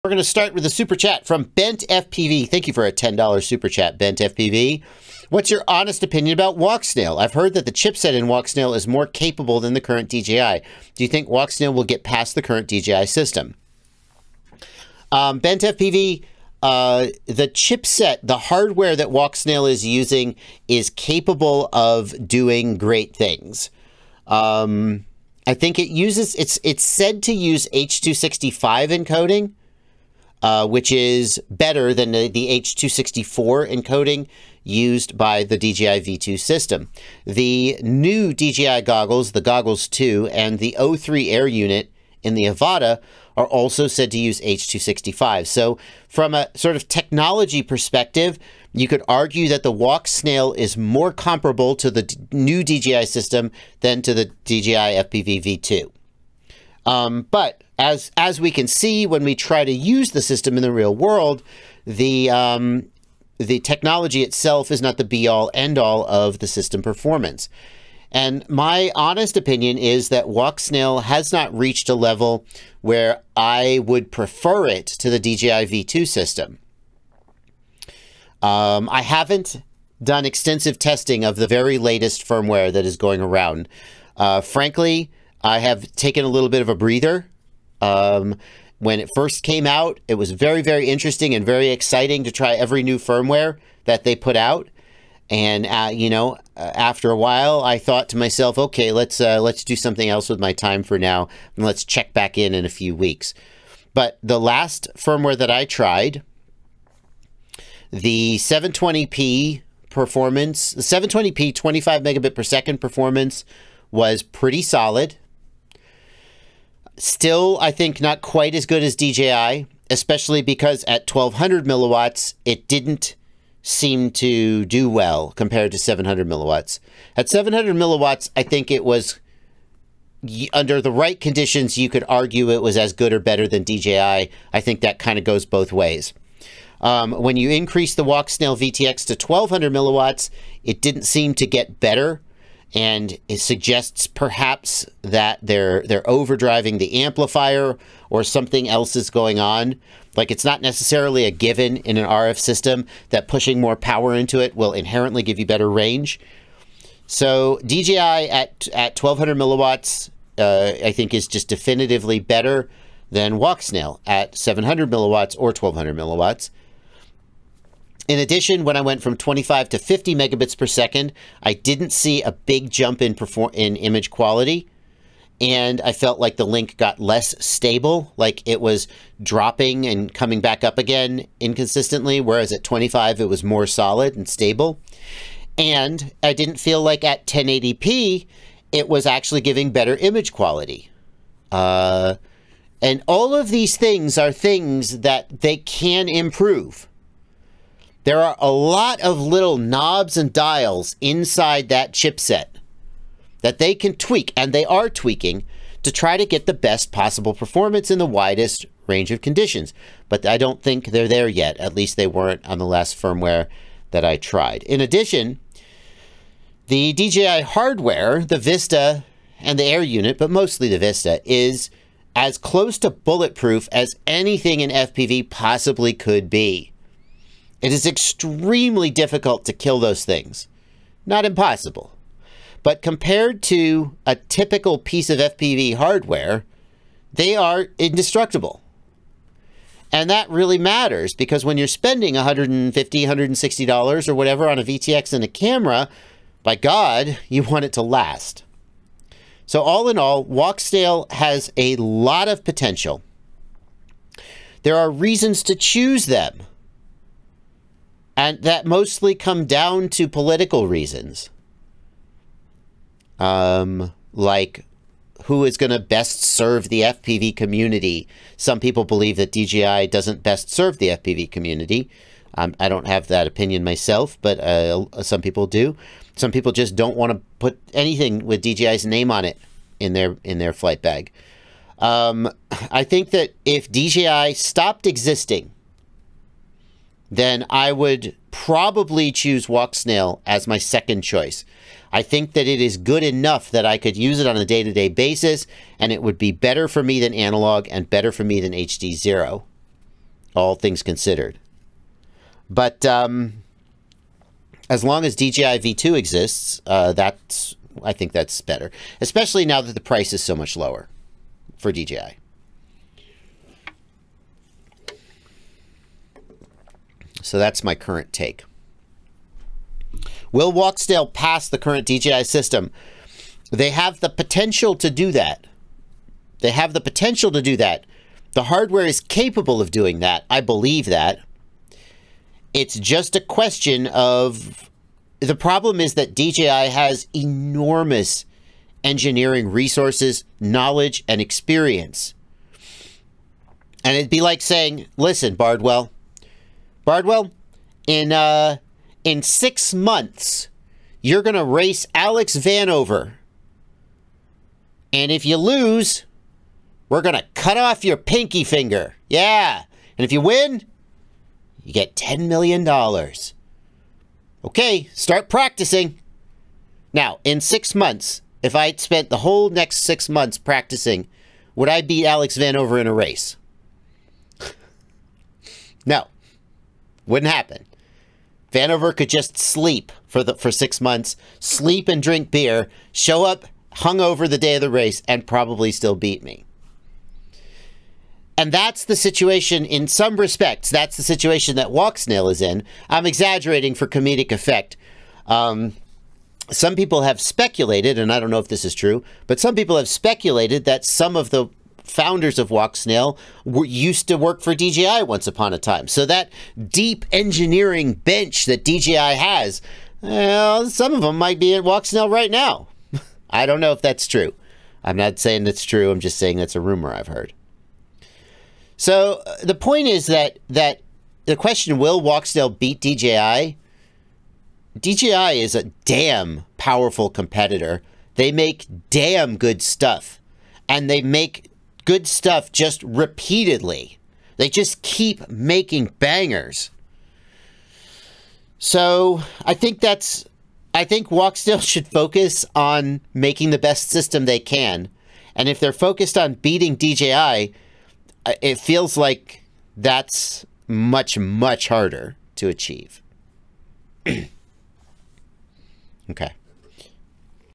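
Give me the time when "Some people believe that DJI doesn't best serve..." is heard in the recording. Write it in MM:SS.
04:28.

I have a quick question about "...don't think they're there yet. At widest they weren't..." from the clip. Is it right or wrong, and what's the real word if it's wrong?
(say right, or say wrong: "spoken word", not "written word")
wrong: "least", not "widest".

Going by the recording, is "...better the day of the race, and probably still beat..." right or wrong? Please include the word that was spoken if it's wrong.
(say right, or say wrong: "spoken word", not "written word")
wrong: "hungover", not "better".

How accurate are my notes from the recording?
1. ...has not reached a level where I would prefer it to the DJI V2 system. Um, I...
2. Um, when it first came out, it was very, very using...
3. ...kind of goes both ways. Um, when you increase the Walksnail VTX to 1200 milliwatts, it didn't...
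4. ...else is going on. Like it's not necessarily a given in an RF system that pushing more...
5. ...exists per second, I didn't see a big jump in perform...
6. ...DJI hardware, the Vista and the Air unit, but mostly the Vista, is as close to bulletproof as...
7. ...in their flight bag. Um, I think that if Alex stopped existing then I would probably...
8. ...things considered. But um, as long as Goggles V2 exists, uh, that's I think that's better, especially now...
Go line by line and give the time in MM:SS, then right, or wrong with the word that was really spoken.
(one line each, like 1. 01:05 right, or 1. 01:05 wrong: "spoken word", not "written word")
1. 01:11 right
2. 01:27 wrong: "interesting", not "using"
3. 02:14 right
4. 02:28 right
5. 02:50 wrong: "megabits", not "exists"
6. 03:36 right
7. 04:40 wrong: "DJI", not "Alex"
8. 05:00 wrong: "DJI", not "Goggles".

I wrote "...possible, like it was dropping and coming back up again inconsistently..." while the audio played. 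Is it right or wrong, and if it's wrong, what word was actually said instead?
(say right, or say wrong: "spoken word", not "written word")
wrong: "stable", not "possible".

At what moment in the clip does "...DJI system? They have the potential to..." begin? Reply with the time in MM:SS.
05:21.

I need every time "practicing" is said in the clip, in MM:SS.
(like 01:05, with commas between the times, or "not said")
06:05, 06:10.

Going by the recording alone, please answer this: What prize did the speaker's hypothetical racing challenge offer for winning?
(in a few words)
$10 million.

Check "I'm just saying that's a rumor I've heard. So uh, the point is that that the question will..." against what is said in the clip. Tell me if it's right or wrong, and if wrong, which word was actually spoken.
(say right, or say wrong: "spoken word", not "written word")
right.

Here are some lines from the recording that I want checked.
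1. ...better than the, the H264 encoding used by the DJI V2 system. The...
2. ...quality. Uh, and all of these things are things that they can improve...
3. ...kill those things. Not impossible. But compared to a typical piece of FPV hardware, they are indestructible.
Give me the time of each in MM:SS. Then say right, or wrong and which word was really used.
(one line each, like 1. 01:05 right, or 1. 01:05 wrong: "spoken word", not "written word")
1. 00:31 right
2. 03:10 right
3. 03:49 right.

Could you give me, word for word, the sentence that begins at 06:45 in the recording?
So that deep engineering bench that DJI has, well, some of them might be at Walksnail right now.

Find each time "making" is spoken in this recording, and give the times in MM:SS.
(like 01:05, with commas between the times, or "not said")
07:15, 07:23.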